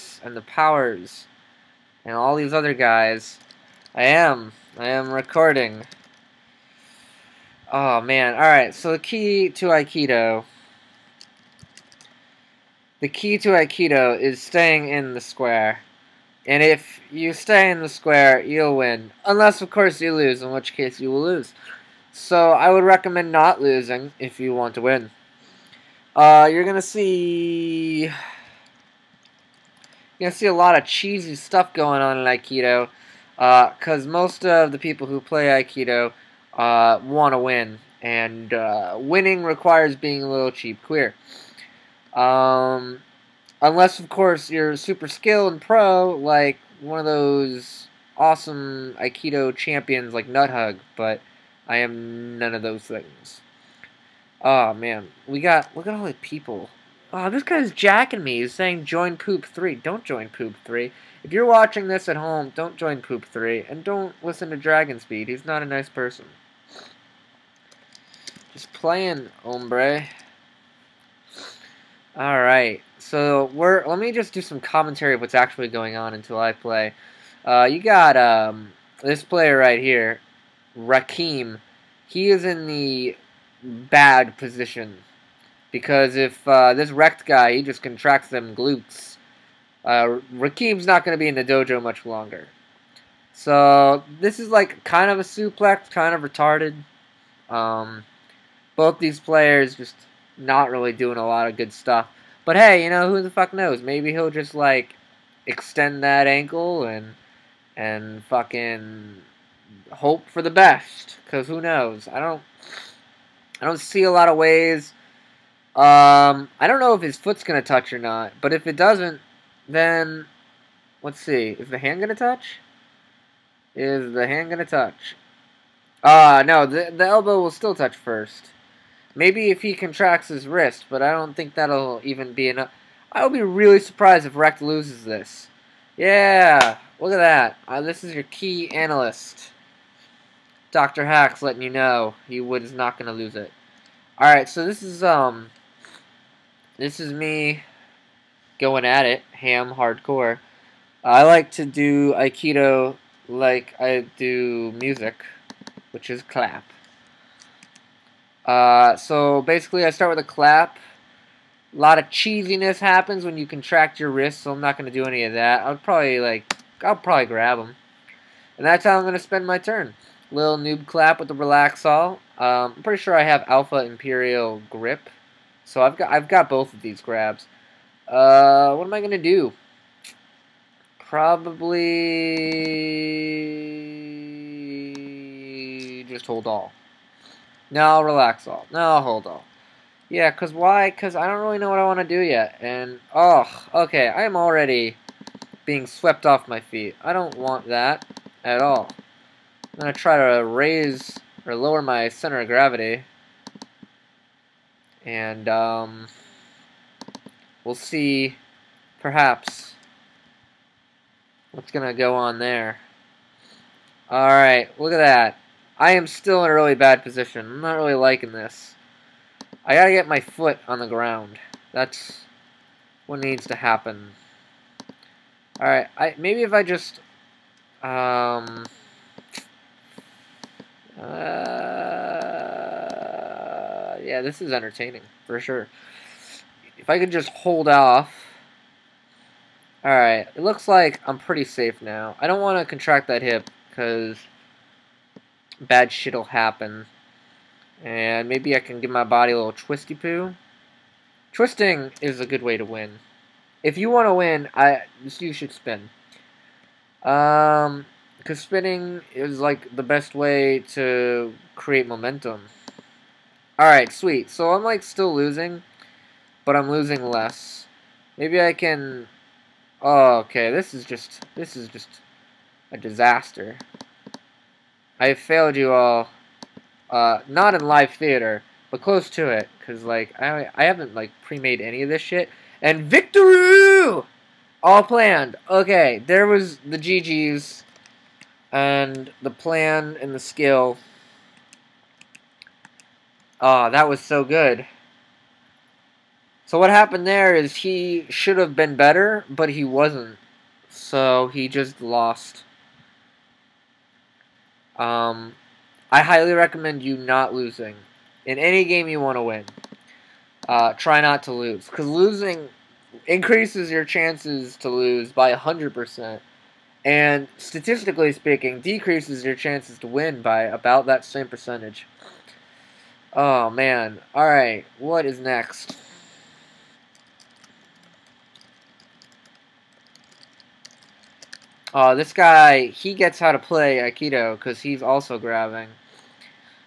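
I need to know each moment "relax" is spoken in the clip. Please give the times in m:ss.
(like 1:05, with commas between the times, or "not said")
2:51, 3:07.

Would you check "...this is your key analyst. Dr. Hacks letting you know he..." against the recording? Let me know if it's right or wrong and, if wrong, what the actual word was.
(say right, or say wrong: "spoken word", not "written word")
right.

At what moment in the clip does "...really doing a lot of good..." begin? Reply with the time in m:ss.
1:40.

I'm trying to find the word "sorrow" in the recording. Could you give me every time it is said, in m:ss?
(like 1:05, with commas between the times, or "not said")
not said.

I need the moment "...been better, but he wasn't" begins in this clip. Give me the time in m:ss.
4:58.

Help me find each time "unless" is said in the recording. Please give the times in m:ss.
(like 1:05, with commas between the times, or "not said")
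0:19, 0:43.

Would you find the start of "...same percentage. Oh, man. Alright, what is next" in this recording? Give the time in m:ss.
5:21.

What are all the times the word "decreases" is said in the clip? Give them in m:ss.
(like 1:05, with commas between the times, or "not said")
5:18.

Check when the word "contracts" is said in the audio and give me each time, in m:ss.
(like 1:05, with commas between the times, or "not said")
1:27, 2:09, 2:43, 4:02.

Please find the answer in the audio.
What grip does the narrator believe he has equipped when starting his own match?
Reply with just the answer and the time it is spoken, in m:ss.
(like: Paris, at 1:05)
Alpha Imperial Grip, at 2:53.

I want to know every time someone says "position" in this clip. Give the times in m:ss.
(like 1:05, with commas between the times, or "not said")
1:24, 3:37.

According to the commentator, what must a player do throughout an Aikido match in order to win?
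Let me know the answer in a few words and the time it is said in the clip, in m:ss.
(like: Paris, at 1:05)
Staying in the square, at 0:14.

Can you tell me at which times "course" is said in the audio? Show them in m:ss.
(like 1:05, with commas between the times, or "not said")
0:19, 0:44.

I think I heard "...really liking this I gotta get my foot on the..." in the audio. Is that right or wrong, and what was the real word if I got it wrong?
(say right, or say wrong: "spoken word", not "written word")
right.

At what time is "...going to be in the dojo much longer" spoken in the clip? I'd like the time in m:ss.
1:31.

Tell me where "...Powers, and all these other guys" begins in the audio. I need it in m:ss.
0:00.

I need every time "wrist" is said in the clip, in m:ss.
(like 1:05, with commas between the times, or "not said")
2:10, 2:44.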